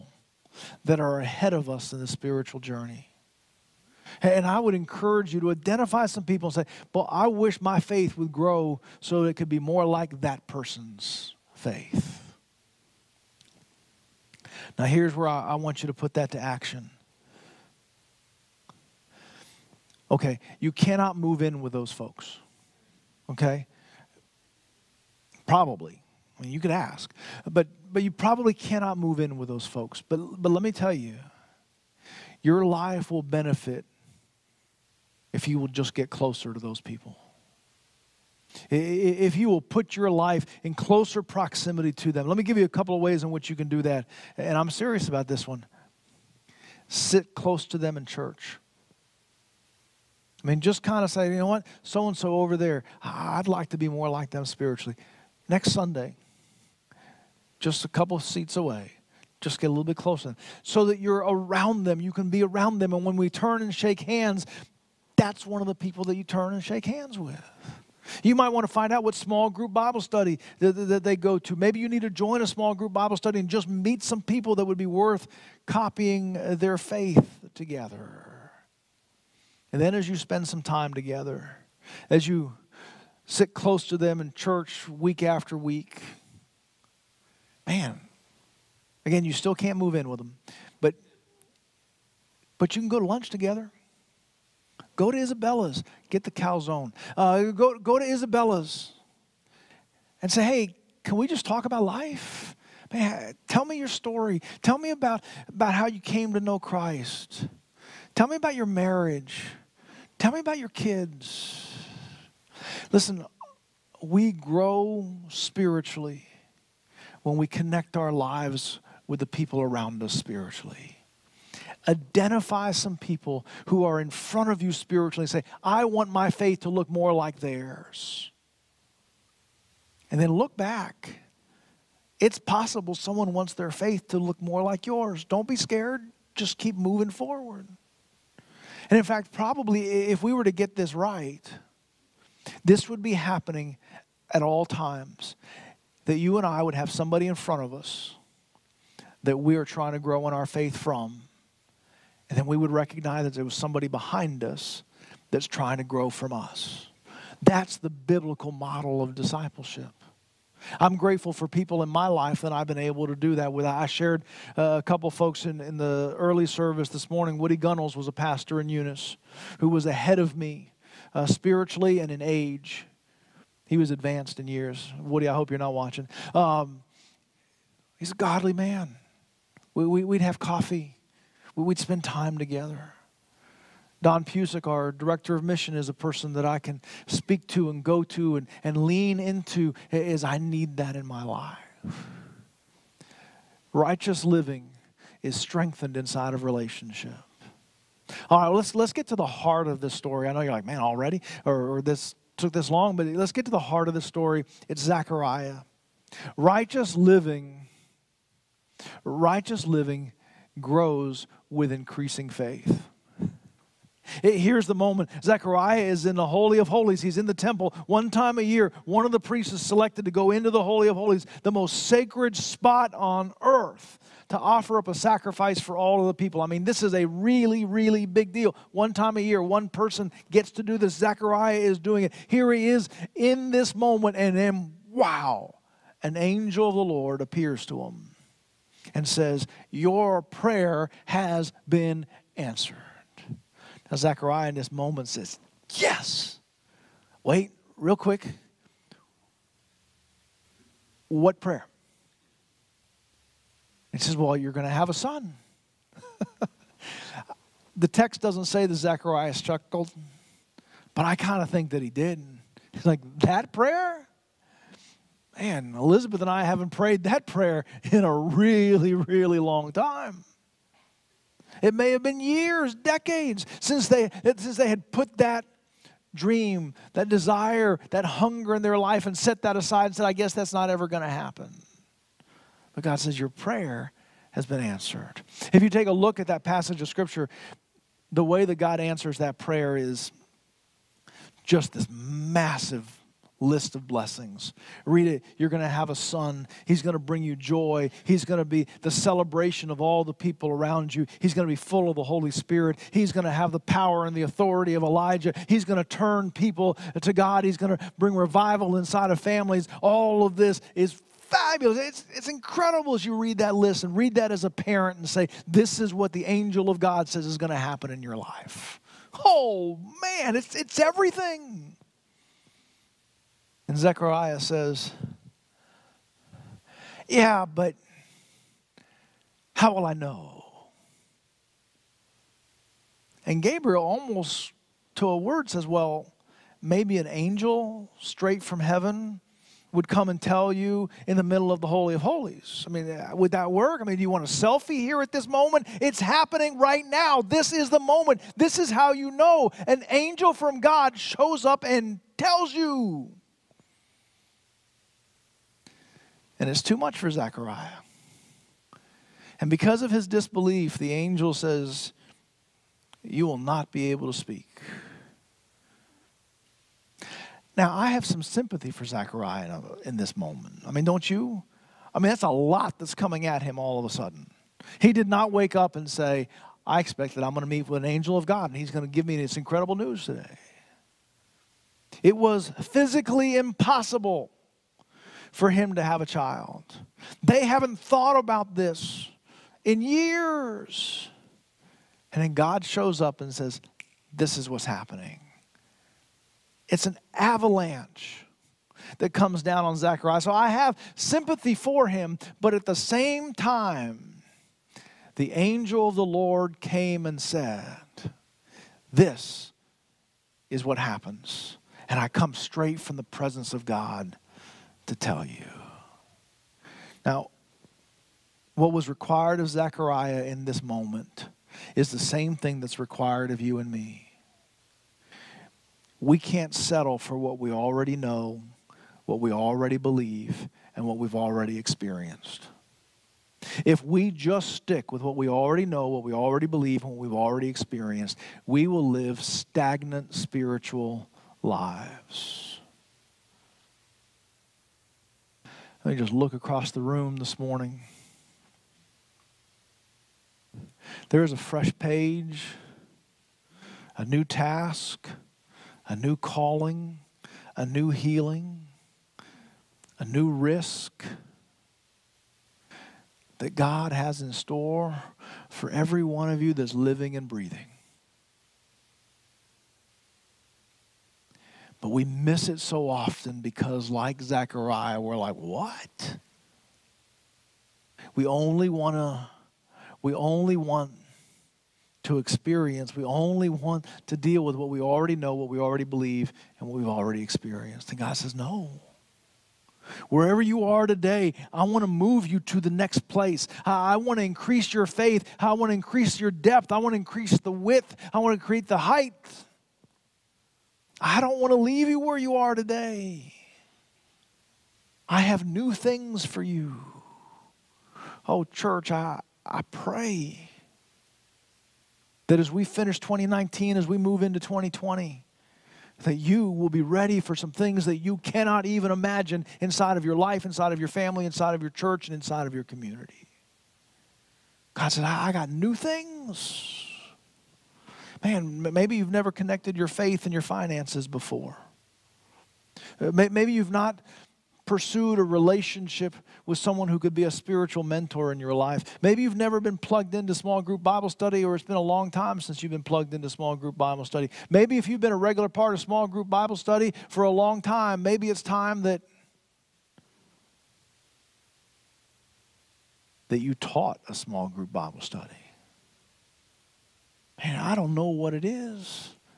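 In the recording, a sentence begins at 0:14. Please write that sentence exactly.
Now, here's where I, I want you to put that to action.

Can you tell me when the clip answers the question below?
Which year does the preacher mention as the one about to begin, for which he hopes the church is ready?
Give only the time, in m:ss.
8:34.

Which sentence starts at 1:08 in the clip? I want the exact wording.
You might want to find out what small group Bible study that, that, they go to.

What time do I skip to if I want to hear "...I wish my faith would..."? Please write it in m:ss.
0:07.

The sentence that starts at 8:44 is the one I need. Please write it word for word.
God said, I, I got new things.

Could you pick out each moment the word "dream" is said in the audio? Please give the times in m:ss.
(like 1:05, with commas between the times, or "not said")
4:36.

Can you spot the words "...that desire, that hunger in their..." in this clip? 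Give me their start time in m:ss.
4:36.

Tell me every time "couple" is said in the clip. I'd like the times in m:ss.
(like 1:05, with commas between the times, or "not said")
0:42, 0:57, 2:44.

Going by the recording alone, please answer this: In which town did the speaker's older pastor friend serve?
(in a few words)
Eunice.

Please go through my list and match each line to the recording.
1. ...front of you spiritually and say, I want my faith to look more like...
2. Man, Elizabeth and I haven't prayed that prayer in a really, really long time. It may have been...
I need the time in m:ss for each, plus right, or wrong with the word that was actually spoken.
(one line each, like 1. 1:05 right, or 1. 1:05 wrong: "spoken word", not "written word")
1. 2:04 right
2. 4:25 right.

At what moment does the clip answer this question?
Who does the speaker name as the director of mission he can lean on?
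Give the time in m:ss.
3:04.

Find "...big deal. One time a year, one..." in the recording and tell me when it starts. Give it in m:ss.
3:48.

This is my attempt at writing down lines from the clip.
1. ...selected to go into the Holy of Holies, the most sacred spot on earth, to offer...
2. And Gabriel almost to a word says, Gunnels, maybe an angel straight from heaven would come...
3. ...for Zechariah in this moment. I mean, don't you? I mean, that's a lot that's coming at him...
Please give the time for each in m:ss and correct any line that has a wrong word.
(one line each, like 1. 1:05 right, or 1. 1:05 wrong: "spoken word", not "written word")
1. 3:39 right
2. 5:33 wrong: "Well", not "Gunnels"
3. 6:08 right.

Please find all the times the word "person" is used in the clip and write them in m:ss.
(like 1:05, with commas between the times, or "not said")
0:10, 3:05, 3:49.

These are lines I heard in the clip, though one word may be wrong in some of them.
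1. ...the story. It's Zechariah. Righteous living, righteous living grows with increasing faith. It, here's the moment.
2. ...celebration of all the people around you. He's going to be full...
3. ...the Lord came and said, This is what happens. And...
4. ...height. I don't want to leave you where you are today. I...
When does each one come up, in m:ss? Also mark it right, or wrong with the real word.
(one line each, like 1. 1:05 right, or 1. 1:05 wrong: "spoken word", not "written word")
1. 3:23 right
2. 4:58 right
3. 6:45 right
4. 8:18 right.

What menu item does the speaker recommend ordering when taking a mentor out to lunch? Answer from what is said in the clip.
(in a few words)
calzone.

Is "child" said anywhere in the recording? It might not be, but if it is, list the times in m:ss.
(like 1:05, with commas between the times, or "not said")
6:26.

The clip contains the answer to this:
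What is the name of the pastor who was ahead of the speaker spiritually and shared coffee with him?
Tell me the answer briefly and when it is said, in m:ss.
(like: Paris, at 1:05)
Woody Gunnels, at 2:47.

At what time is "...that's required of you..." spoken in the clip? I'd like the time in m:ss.
7:02.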